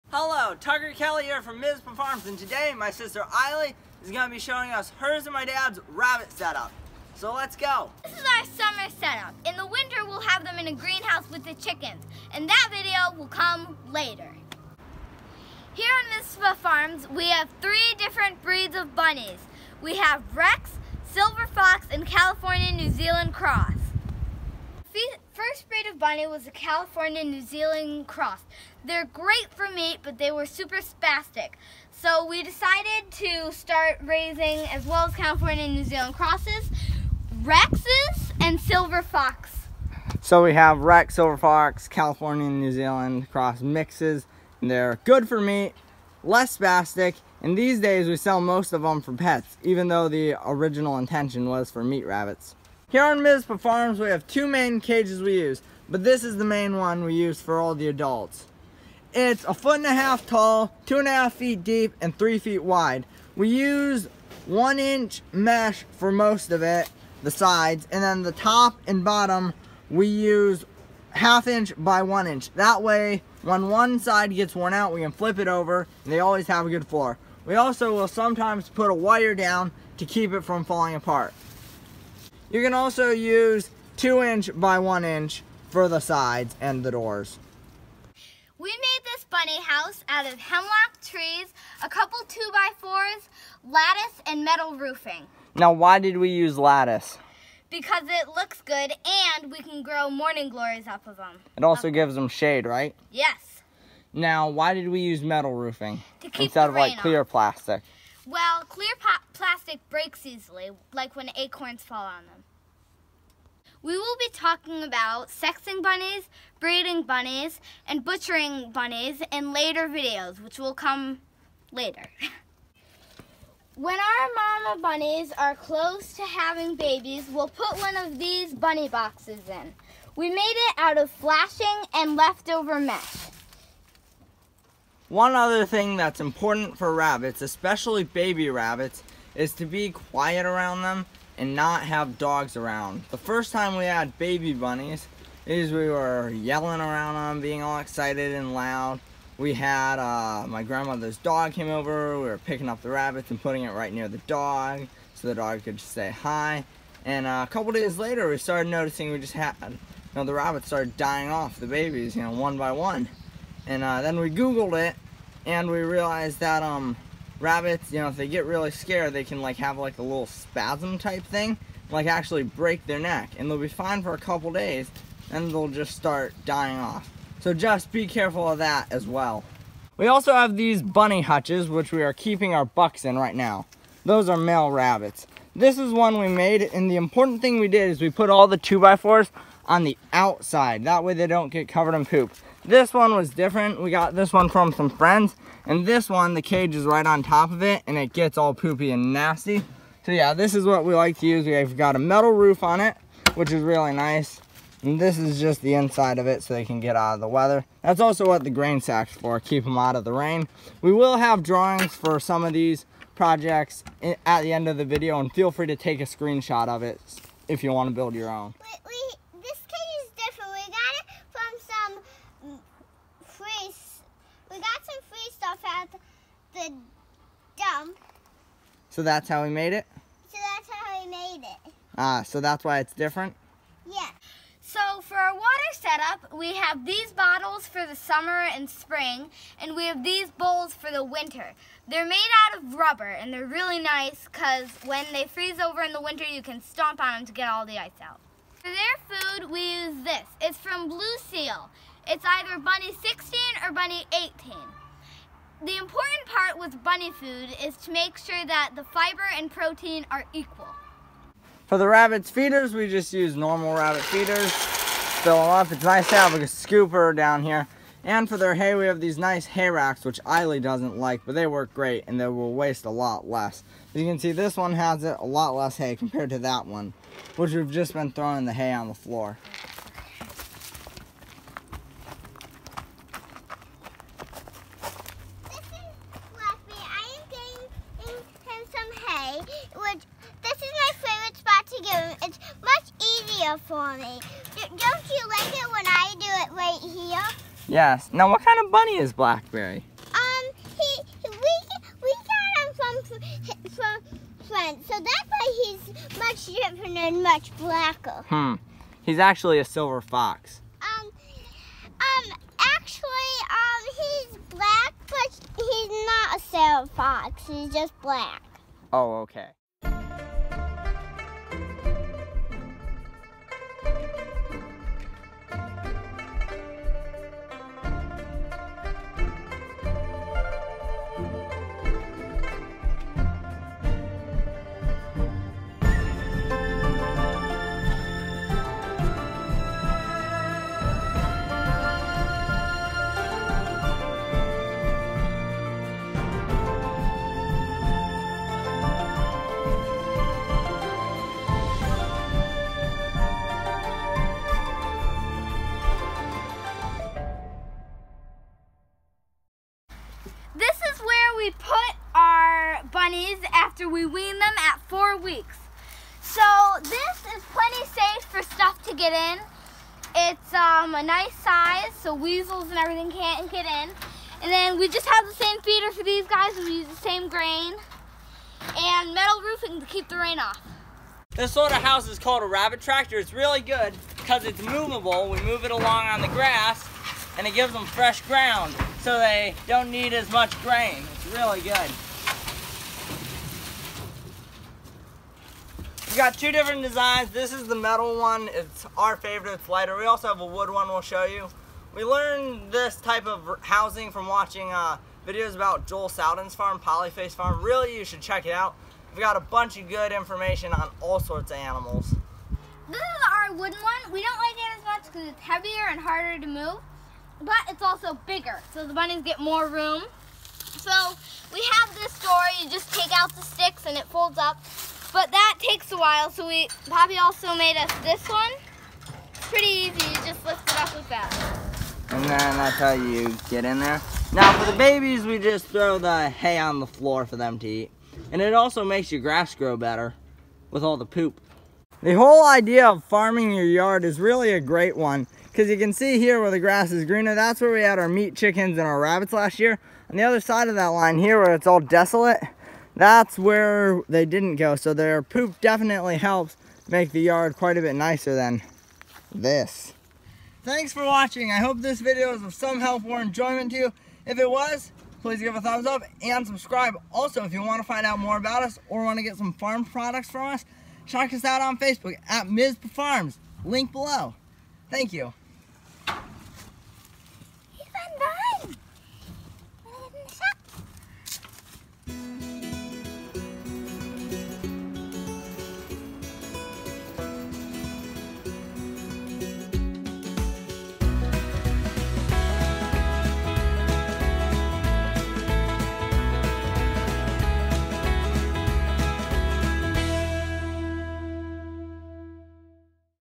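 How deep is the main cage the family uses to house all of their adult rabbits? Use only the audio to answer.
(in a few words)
2.5 feet.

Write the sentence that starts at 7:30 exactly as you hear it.
On the other side of that line here where it's all desolate, that's where they didn't go.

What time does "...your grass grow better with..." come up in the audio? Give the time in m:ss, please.
7:19.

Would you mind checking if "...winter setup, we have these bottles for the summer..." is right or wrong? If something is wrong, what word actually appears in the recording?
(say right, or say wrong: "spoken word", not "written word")
wrong: "water", not "winter".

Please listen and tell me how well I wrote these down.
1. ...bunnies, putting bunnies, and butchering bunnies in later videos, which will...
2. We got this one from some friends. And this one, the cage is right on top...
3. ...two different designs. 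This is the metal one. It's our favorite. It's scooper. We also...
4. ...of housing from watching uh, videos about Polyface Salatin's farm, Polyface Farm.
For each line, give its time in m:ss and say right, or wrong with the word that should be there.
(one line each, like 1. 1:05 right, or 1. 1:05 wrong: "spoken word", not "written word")
1. 1:55 wrong: "breeding", not "putting"
2. 3:13 right
3. 6:36 wrong: "lighter", not "scooper"
4. 6:43 wrong: "Joel", not "Polyface".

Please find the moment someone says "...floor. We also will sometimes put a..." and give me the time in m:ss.
1:16.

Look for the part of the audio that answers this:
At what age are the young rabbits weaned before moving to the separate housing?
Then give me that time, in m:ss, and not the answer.
6:04.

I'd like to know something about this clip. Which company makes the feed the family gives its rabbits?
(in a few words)
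Blue Seal.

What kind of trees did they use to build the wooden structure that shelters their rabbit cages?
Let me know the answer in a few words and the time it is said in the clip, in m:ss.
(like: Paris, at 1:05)
Hemlock, at 1:30.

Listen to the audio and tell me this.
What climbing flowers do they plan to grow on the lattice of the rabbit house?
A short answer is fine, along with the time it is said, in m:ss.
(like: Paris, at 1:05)
Morning glories, at 1:40.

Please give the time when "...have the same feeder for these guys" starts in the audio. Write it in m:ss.
6:15.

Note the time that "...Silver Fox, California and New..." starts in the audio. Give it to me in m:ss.
0:41.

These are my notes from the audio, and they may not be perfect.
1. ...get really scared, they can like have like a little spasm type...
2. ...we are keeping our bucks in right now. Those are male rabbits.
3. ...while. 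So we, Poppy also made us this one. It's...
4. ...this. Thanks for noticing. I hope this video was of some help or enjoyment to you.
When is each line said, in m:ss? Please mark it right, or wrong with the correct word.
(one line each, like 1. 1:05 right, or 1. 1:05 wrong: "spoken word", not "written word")
1. 2:48 right
2. 3:01 right
3. 7:06 right
4. 7:39 wrong: "watching", not "noticing".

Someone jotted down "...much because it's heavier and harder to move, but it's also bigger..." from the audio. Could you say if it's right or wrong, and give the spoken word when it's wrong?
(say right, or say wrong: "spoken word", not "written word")
right.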